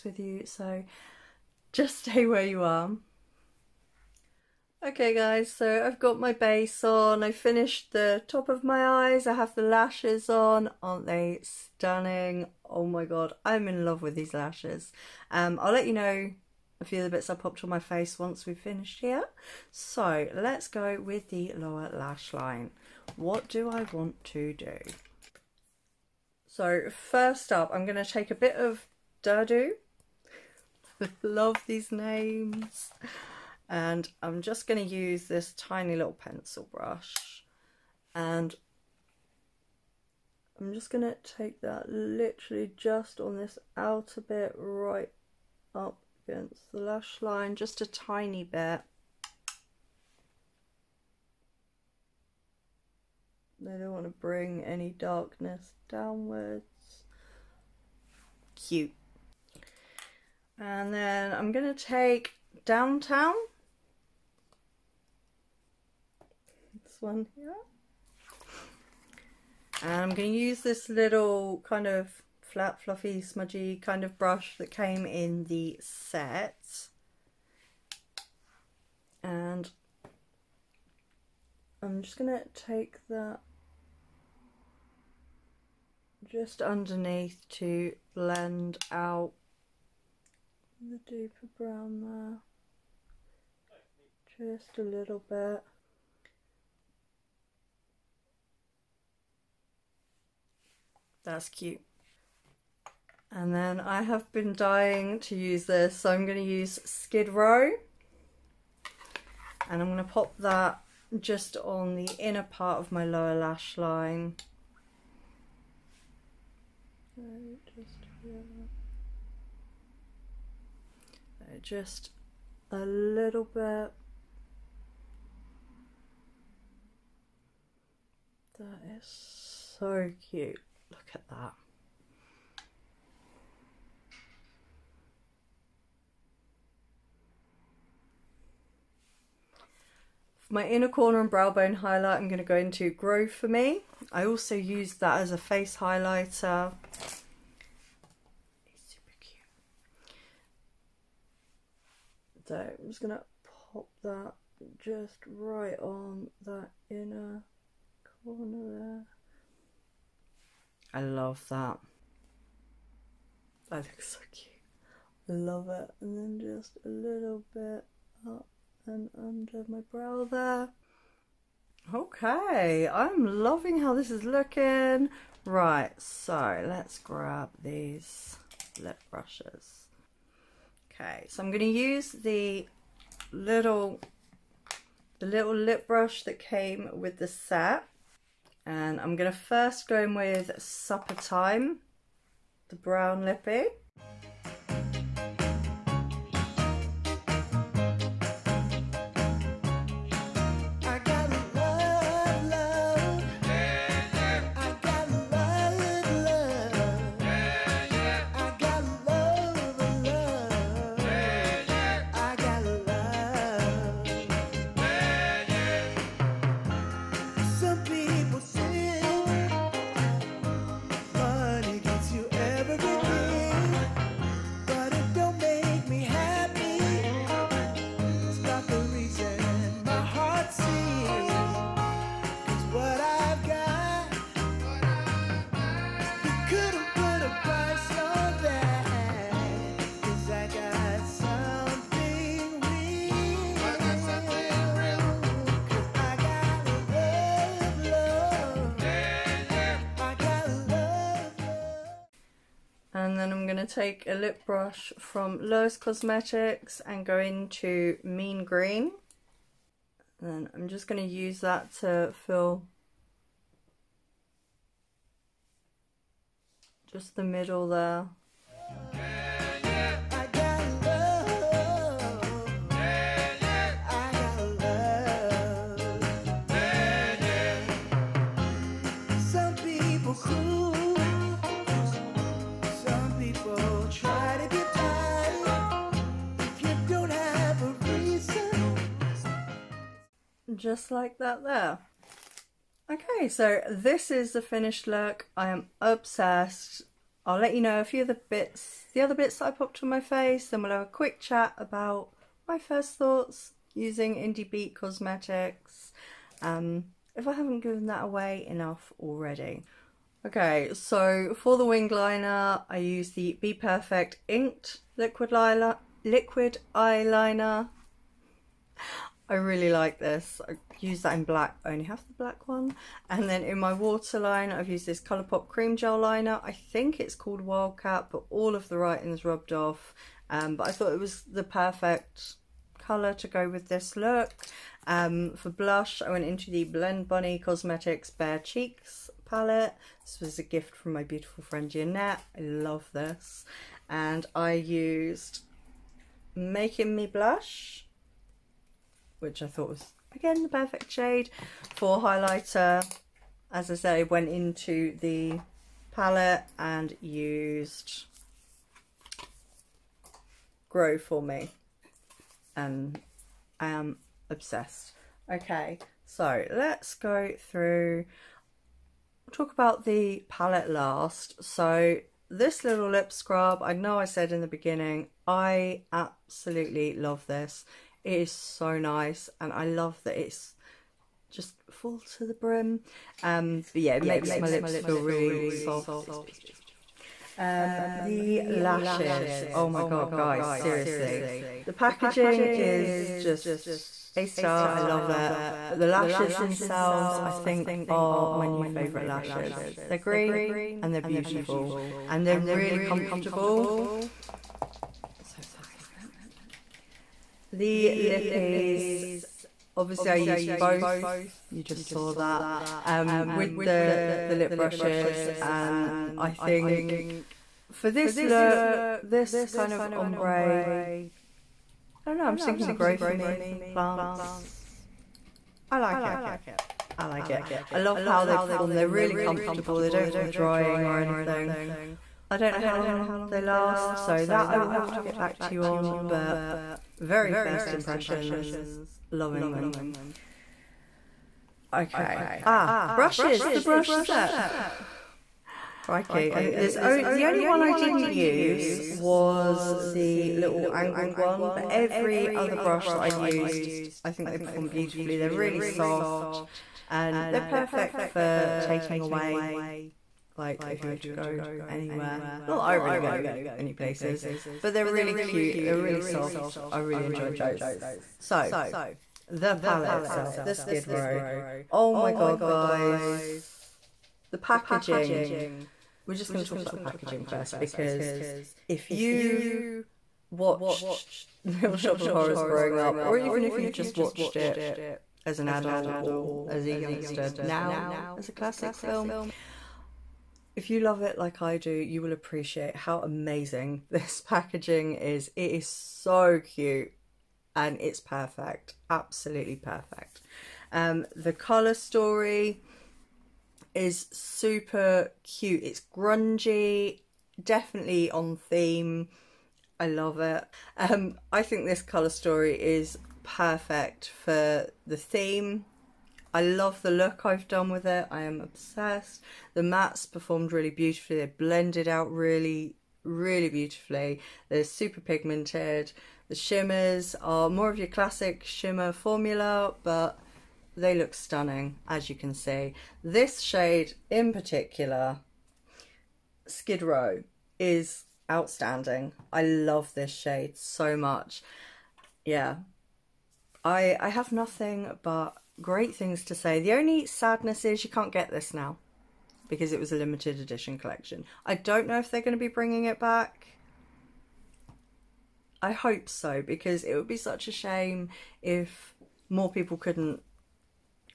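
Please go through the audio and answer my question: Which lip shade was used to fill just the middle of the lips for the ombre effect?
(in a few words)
Mean Green.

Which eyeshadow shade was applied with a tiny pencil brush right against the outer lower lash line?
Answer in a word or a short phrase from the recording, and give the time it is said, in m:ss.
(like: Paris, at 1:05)
Durdu, at 0:29.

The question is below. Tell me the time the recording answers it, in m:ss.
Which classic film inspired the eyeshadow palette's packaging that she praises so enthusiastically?
8:01.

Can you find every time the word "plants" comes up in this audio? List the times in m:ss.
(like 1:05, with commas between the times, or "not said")
7:03.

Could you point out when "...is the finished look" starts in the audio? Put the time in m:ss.
4:54.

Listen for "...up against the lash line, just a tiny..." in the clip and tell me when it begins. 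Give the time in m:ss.
0:45.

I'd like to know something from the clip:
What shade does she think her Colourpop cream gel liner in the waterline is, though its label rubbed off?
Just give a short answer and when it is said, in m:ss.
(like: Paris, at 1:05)
Wildcat, at 5:27.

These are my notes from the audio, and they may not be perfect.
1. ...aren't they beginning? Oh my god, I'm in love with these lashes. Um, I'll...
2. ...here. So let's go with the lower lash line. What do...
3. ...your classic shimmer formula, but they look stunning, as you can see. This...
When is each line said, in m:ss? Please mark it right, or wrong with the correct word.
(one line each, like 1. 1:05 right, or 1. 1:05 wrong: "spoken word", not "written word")
1. 0:10 wrong: "stunning", not "beginning"
2. 0:19 right
3. 8:47 right.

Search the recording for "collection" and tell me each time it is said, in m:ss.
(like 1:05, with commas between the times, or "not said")
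9:10.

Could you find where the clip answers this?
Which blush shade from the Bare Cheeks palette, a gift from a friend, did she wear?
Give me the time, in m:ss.
5:46.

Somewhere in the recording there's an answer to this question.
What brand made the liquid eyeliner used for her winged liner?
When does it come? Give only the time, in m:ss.
5:13.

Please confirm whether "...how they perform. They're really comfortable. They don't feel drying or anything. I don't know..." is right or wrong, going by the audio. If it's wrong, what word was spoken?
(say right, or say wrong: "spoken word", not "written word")
right.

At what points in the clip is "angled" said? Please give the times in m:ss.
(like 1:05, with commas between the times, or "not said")
7:30.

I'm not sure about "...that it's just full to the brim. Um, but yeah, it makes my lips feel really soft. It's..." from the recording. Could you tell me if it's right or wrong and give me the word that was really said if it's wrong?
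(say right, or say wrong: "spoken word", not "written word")
right.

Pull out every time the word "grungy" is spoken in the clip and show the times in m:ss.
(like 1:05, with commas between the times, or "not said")
8:25.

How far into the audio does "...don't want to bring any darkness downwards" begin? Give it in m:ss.
0:53.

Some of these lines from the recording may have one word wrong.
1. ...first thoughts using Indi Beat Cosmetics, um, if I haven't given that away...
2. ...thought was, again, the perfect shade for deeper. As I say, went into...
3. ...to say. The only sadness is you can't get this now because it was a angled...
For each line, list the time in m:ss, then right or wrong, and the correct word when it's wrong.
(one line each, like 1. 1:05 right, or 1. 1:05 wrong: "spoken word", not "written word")
1. 5:02 right
2. 5:49 wrong: "highlighter", not "deeper"
3. 9:06 wrong: "limited", not "angled".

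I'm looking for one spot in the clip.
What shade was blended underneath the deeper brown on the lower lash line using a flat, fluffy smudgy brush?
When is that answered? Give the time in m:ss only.
1:02.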